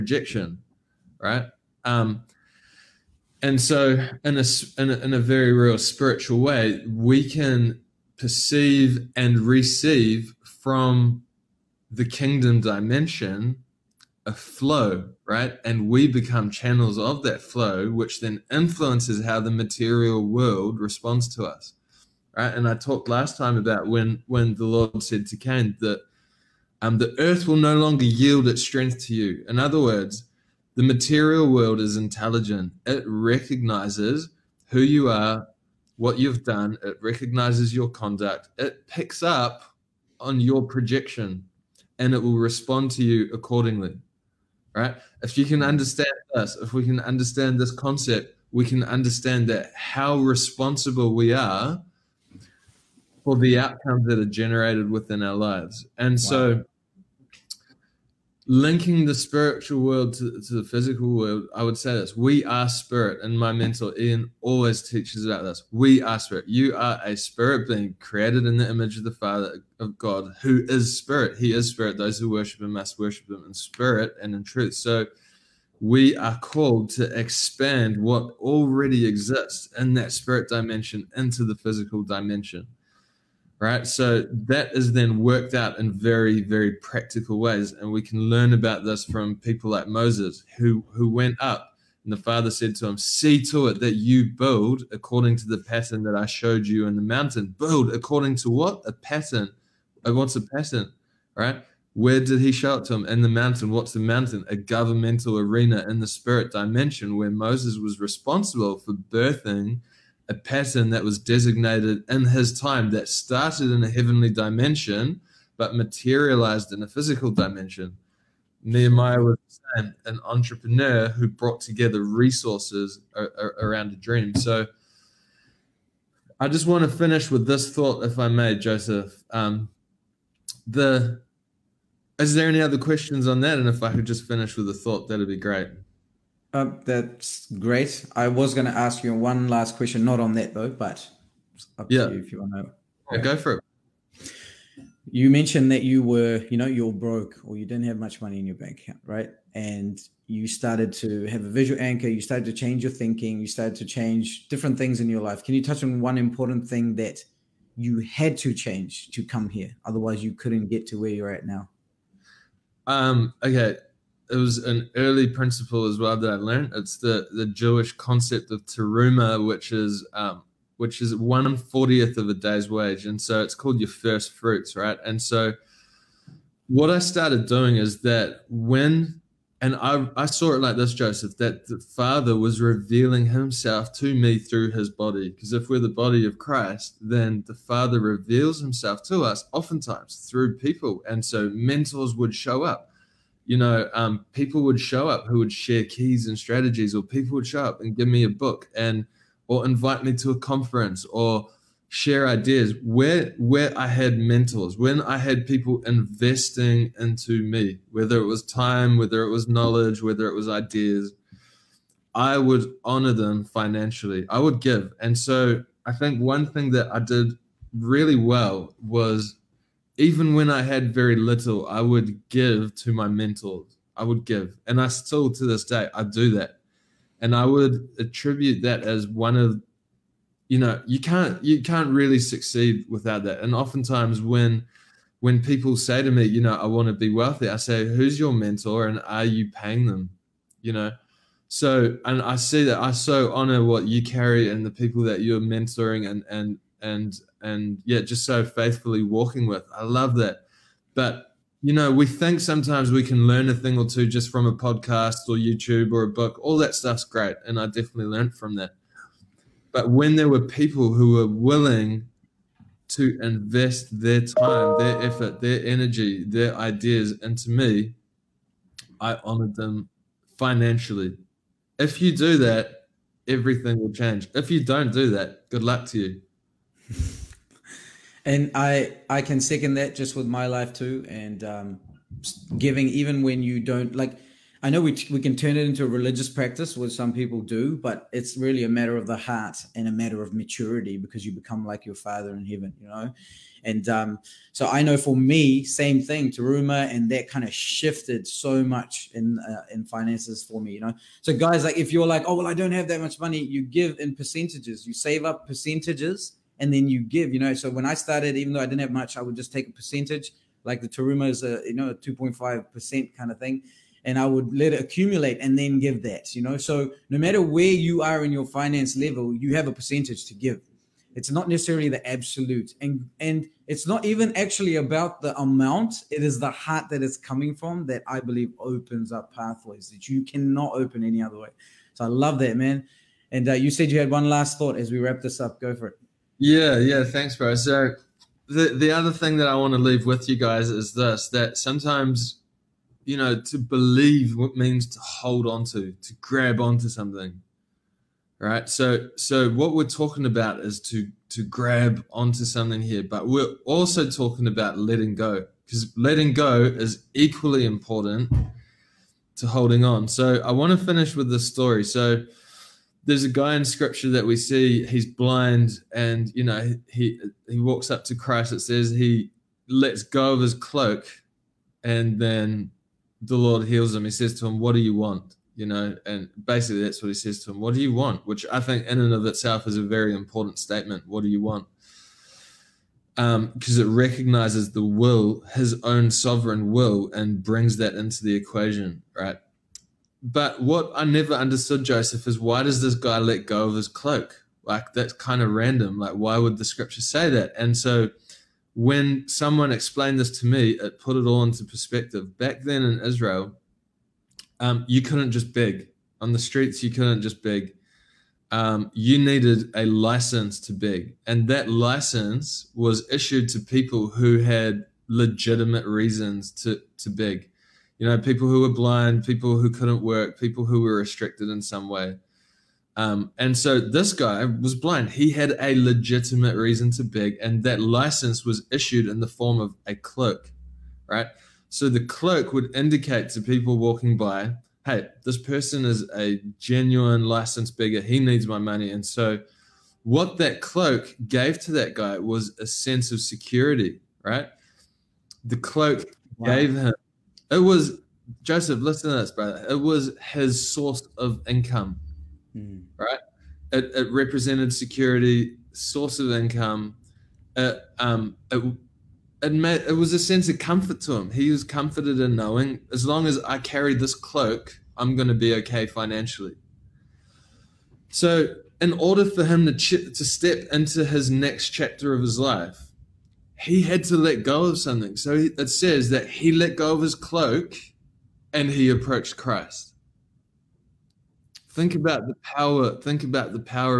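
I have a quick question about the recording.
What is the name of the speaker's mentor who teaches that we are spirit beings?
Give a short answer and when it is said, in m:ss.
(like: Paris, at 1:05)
Ian, at 1:03.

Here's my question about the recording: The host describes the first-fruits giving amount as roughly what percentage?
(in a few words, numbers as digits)
2.5%.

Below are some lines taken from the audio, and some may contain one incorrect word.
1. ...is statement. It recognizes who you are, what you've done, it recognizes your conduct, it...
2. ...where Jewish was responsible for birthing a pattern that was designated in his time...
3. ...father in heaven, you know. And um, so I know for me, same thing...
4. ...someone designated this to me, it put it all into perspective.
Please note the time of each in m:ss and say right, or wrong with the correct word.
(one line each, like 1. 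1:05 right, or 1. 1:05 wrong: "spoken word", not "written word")
1. 0:31 wrong: "intelligent", not "statement"
2. 1:47 wrong: "Moses", not "Jewish"
3. 4:51 right
4. 6:39 wrong: "explained", not "designated".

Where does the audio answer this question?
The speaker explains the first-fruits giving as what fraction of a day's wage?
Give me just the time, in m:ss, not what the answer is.
2:51.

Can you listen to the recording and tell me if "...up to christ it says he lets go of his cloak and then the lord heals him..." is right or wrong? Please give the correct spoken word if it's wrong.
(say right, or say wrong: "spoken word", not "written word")
right.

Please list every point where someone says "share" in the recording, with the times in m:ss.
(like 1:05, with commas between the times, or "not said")
3:15, 3:21.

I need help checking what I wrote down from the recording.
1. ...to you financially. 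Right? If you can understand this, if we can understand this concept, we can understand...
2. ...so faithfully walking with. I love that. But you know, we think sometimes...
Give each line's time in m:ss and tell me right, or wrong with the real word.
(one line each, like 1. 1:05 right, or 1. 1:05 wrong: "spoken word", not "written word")
1. 0:42 wrong: "accordingly", not "financially"
2. 4:08 right.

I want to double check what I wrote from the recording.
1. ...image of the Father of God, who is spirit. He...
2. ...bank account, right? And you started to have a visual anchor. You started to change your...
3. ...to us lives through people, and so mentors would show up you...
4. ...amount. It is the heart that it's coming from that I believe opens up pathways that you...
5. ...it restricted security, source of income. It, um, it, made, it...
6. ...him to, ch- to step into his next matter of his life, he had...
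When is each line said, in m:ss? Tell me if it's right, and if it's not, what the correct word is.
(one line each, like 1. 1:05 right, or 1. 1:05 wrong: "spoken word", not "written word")
1. 1:08 right
2. 2:28 right
3. 3:09 wrong: "oftentimes", not "lives"
4. 5:25 right
5. 7:33 wrong: "represented", not "restricted"
6. 7:49 wrong: "chapter", not "matter".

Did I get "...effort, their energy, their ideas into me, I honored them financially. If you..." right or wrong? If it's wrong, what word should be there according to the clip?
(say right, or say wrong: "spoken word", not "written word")
right.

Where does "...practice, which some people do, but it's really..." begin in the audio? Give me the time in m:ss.
4:46.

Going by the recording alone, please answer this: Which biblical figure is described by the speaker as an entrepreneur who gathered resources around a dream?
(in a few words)
Nehemiah.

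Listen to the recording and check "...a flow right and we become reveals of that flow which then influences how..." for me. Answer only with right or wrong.
wrong.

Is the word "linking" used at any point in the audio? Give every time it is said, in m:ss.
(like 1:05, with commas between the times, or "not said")
0:58.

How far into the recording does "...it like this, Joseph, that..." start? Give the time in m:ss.
3:00.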